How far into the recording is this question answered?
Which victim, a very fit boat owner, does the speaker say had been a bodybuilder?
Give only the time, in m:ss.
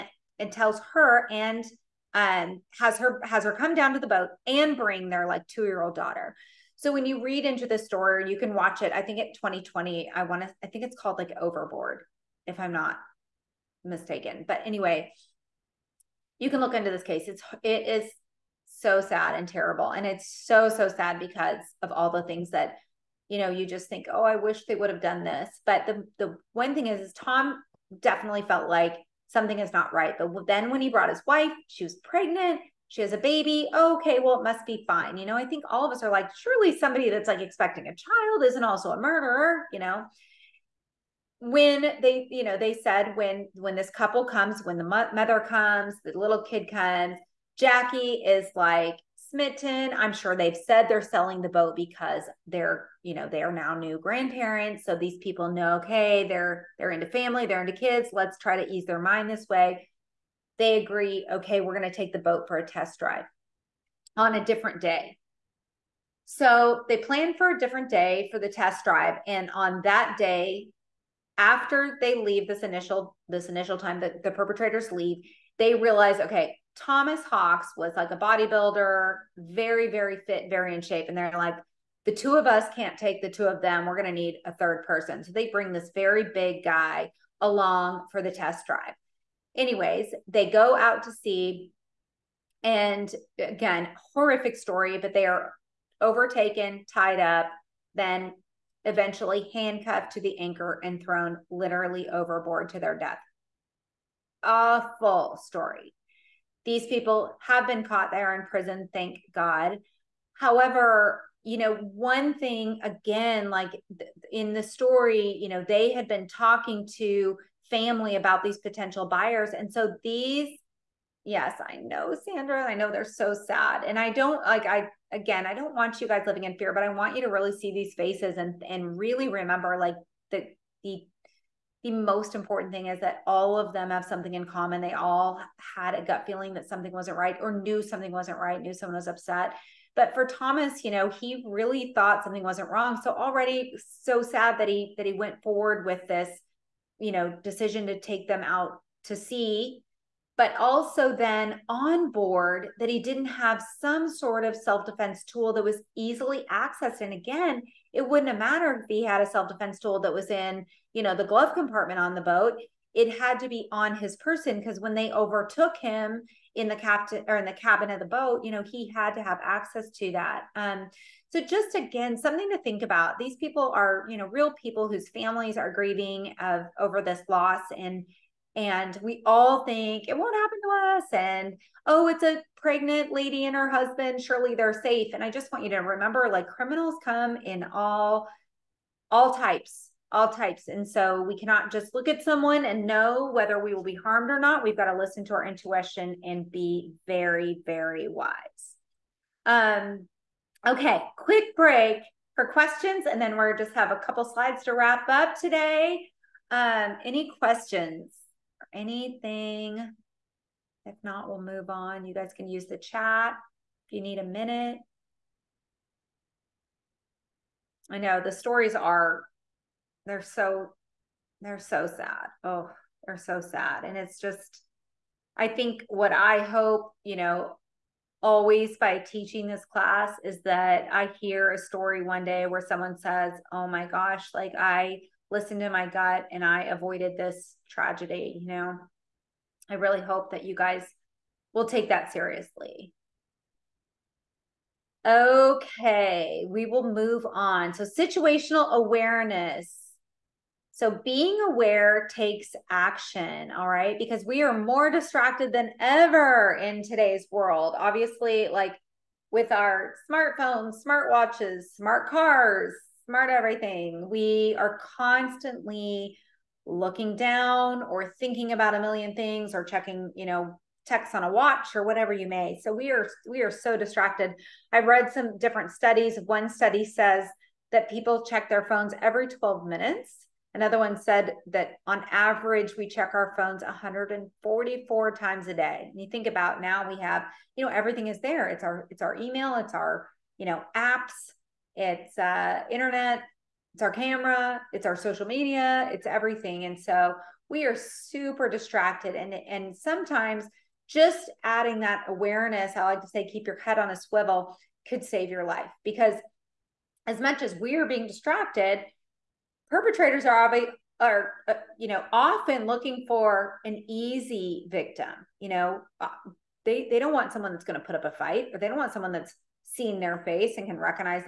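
1:16.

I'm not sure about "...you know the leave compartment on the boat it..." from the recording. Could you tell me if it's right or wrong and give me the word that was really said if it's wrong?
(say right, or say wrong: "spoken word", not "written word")
wrong: "glove", not "leave".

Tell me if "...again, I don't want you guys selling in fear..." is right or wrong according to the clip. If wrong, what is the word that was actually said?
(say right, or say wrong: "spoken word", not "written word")
wrong: "living", not "selling".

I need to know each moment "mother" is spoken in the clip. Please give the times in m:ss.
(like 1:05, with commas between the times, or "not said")
0:45.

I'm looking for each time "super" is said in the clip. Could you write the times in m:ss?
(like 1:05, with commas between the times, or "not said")
4:57.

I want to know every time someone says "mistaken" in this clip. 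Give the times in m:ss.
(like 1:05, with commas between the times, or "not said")
0:13.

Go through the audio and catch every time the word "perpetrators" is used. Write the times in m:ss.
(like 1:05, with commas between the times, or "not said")
1:14, 5:09.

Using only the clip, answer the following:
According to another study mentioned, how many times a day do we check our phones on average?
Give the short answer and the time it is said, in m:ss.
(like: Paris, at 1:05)
144, at 4:43.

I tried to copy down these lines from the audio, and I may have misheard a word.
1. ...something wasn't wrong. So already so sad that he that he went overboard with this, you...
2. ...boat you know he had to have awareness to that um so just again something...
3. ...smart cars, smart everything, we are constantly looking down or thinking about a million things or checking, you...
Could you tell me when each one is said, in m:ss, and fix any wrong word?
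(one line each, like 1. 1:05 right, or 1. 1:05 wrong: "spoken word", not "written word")
1. 2:22 wrong: "forward", not "overboard"
2. 2:48 wrong: "access", not "awareness"
3. 4:21 right.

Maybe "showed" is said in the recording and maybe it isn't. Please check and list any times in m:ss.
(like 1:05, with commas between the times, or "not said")
not said.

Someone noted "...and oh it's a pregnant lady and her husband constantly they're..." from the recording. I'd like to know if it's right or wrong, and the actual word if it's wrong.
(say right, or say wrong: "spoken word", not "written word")
wrong: "surely", not "constantly".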